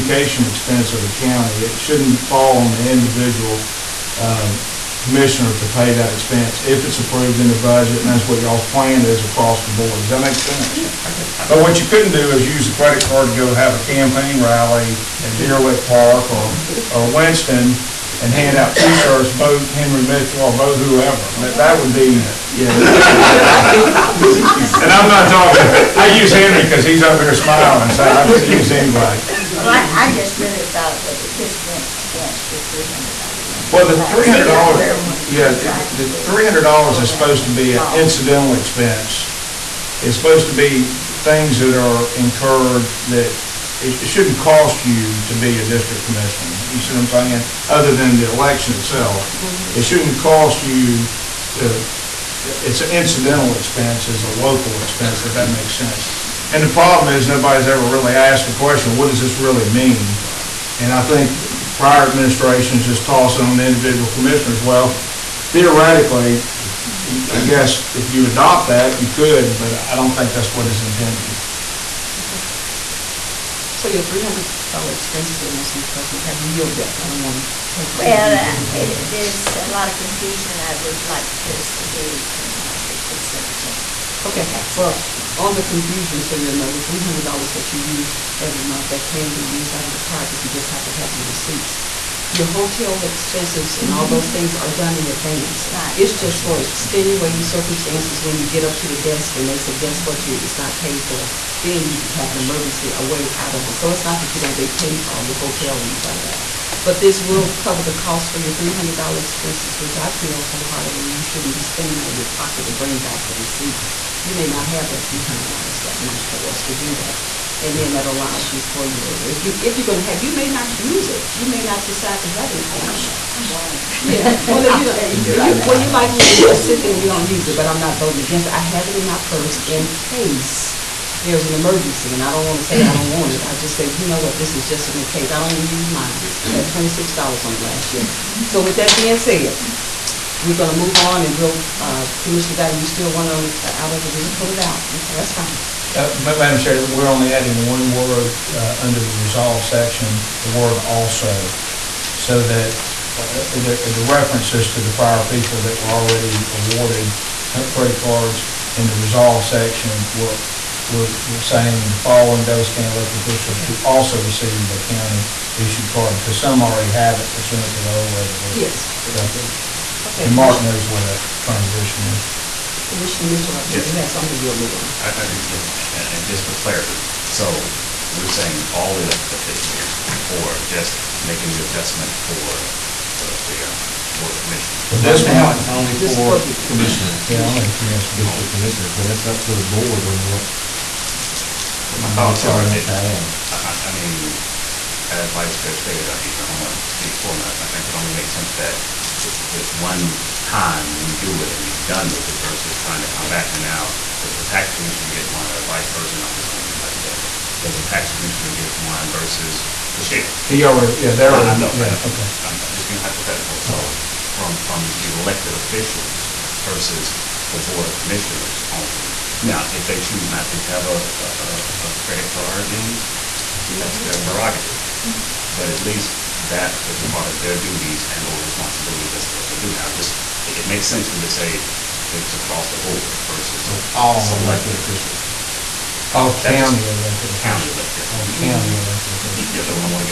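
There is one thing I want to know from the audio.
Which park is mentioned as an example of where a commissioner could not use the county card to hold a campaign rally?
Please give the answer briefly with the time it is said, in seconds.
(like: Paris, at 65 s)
Deer Lick Park, at 15 s.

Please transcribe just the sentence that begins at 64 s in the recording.
Well, theoretically, I guess if you adopt that, you could, but I don't think that's what is intended.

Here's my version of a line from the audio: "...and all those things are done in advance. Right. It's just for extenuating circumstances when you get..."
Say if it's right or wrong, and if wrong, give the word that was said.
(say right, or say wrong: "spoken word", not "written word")
right.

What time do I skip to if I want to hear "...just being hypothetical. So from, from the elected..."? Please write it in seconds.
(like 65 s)
212 s.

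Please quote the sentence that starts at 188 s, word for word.
district commissioners, but that's up to the board on what.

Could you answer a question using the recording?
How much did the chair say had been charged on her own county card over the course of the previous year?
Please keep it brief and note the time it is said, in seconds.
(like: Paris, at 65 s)
$26, at 136 s.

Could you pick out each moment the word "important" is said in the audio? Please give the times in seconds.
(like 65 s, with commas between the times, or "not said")
not said.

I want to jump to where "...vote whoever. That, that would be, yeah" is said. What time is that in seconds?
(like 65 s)
20 s.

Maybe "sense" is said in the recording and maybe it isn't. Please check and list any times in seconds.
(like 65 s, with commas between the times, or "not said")
10 s, 55 s, 198 s, 230 s.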